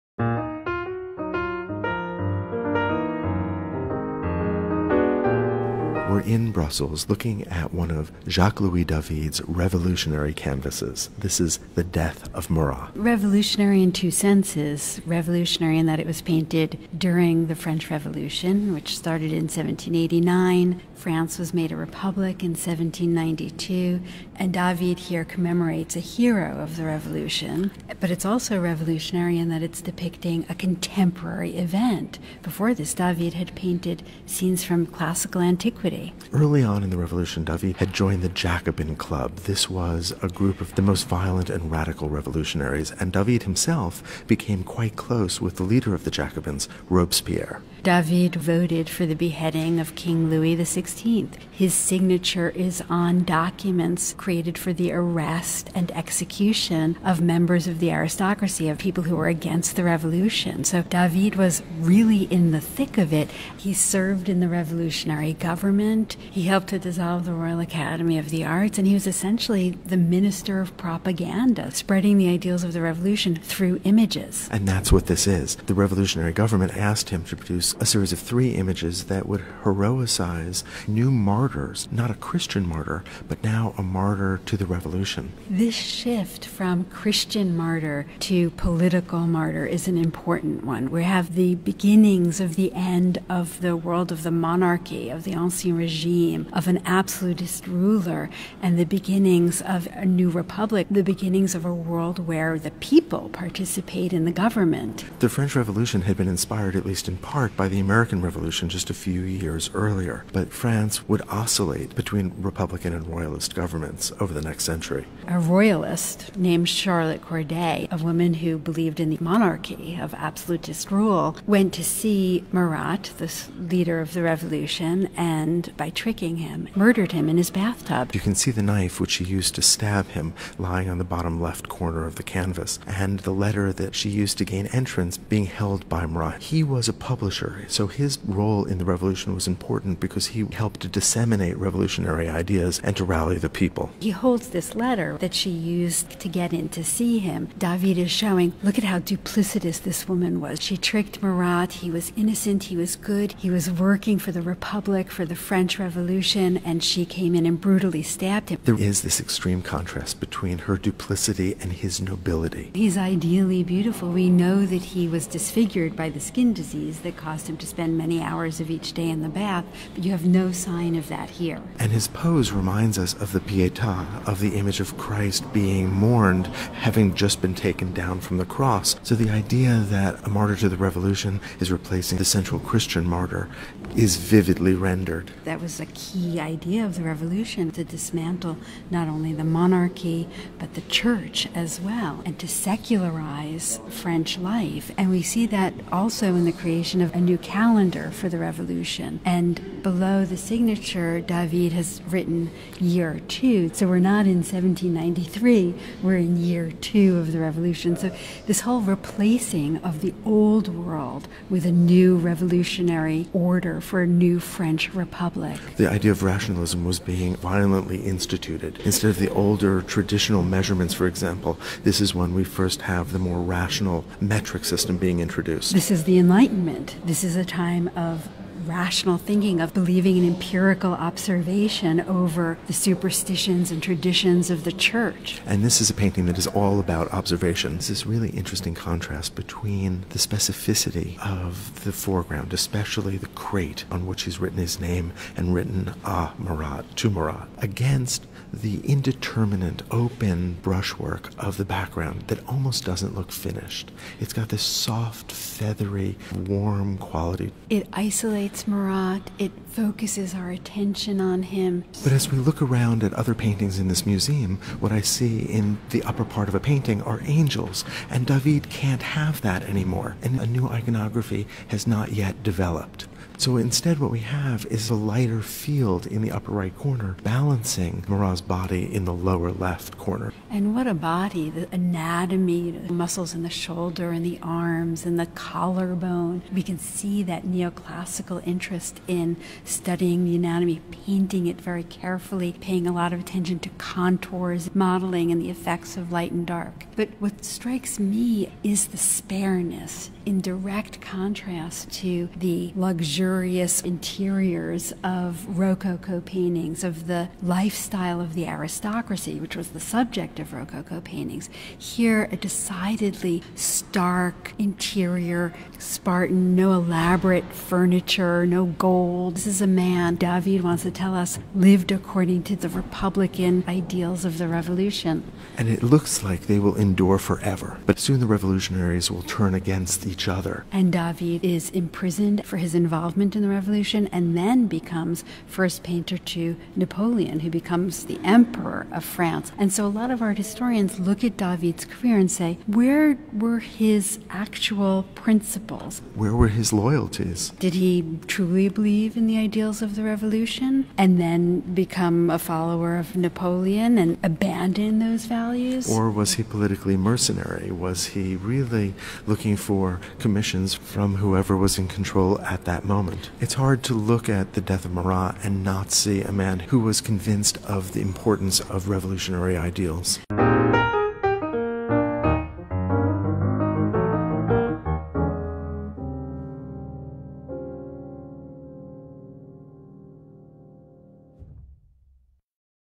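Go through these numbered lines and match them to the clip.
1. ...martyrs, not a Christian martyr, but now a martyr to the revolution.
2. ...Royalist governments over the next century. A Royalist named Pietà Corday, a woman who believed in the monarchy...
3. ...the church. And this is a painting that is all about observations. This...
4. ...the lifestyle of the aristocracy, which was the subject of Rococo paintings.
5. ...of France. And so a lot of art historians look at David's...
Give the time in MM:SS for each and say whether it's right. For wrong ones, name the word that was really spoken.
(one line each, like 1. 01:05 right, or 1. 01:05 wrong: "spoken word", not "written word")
1. 01:21 right
2. 01:53 wrong: "Charlotte", not "Pietà"
3. 03:54 right
4. 05:07 right
5. 05:38 right.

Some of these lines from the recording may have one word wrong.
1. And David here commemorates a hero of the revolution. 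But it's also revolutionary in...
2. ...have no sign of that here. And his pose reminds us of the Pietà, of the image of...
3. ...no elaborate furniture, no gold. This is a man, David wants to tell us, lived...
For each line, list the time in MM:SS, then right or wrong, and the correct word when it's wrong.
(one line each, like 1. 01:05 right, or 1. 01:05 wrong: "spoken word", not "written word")
1. 00:24 right
2. 02:50 right
3. 05:16 right.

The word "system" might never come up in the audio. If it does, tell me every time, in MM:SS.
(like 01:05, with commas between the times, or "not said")
03:44.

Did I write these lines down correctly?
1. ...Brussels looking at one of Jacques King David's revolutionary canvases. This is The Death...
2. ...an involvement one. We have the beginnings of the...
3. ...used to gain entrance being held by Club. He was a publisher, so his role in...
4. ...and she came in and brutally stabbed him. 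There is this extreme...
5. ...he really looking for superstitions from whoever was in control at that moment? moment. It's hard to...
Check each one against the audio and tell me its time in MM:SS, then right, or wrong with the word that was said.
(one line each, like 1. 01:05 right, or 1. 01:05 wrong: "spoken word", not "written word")
1. 00:06 wrong: "Louis", not "King"
2. 01:29 wrong: "important", not "involvement"
3. 02:14 wrong: "Marat", not "Club"
4. 02:36 right
5. 05:58 wrong: "commissions", not "superstitions".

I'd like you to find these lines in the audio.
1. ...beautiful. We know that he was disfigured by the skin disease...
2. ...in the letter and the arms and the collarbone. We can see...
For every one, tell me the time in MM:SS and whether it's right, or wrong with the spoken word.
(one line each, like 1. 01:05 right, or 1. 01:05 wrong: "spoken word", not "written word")
1. 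02:43 right
2. 04:43 wrong: "shoulder", not "letter".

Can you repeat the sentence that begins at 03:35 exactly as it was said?
The idea of rationalism was being violently instituted.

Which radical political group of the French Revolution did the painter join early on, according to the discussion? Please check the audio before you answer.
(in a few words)
Jacobin Club.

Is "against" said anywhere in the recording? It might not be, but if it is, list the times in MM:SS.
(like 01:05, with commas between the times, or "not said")
00:59, 04:07, 05:29.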